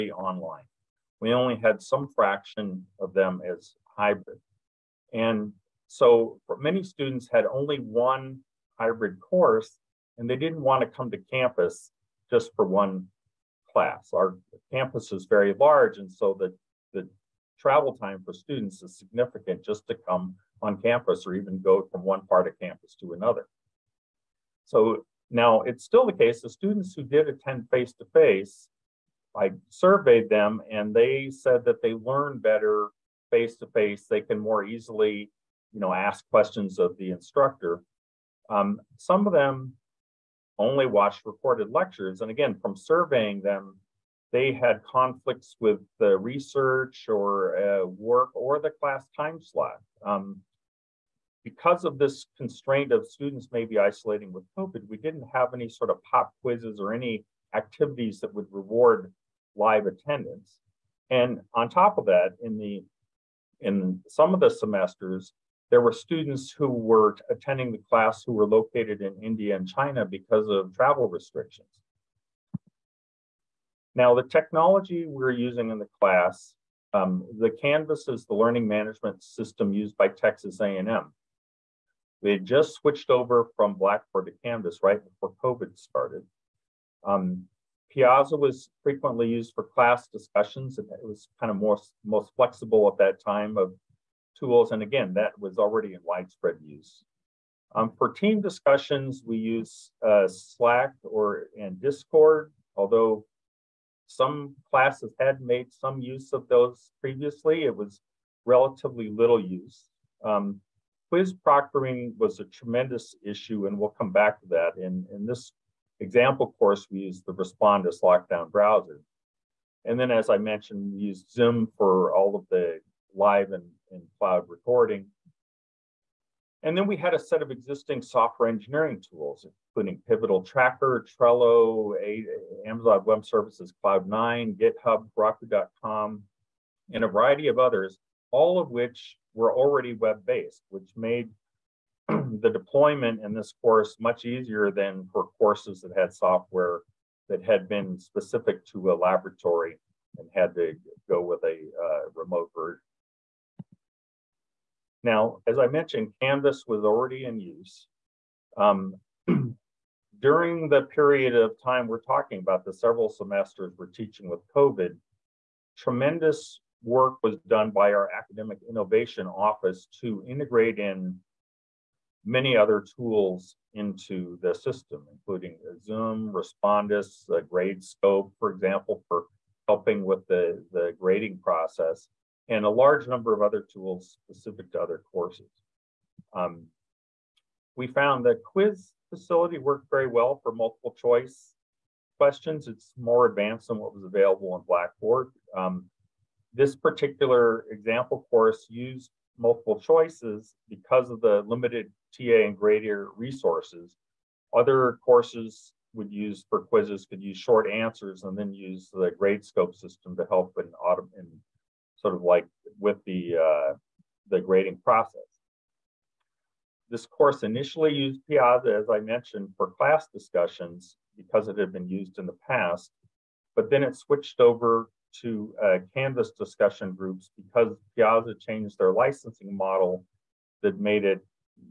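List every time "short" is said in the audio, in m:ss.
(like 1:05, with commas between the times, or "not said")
3:27.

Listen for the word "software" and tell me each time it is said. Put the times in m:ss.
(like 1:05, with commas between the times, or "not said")
2:07, 2:26.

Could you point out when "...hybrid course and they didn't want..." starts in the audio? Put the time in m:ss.
0:08.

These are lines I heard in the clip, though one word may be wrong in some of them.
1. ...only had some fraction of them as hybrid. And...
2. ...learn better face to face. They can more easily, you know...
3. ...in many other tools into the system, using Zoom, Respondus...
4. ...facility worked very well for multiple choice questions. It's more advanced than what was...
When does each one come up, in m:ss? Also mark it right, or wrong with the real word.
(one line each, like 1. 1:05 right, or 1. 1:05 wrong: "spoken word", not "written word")
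1. 0:01 right
2. 0:31 right
3. 2:50 wrong: "including", not "using"
4. 3:09 right.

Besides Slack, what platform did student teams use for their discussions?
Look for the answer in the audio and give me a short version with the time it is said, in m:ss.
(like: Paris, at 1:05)
Discord, at 1:41.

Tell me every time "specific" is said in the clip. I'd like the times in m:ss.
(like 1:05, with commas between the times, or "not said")
2:27, 3:04.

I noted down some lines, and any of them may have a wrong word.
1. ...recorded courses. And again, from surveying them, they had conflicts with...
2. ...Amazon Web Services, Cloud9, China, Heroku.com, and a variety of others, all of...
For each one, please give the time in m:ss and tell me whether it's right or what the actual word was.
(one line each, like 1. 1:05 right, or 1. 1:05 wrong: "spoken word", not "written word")
1. 0:41 wrong: "lectures", not "courses"
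2. 2:12 wrong: "GitHub", not "China".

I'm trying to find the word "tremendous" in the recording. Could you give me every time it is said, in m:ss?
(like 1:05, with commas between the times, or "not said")
1:52, 2:45.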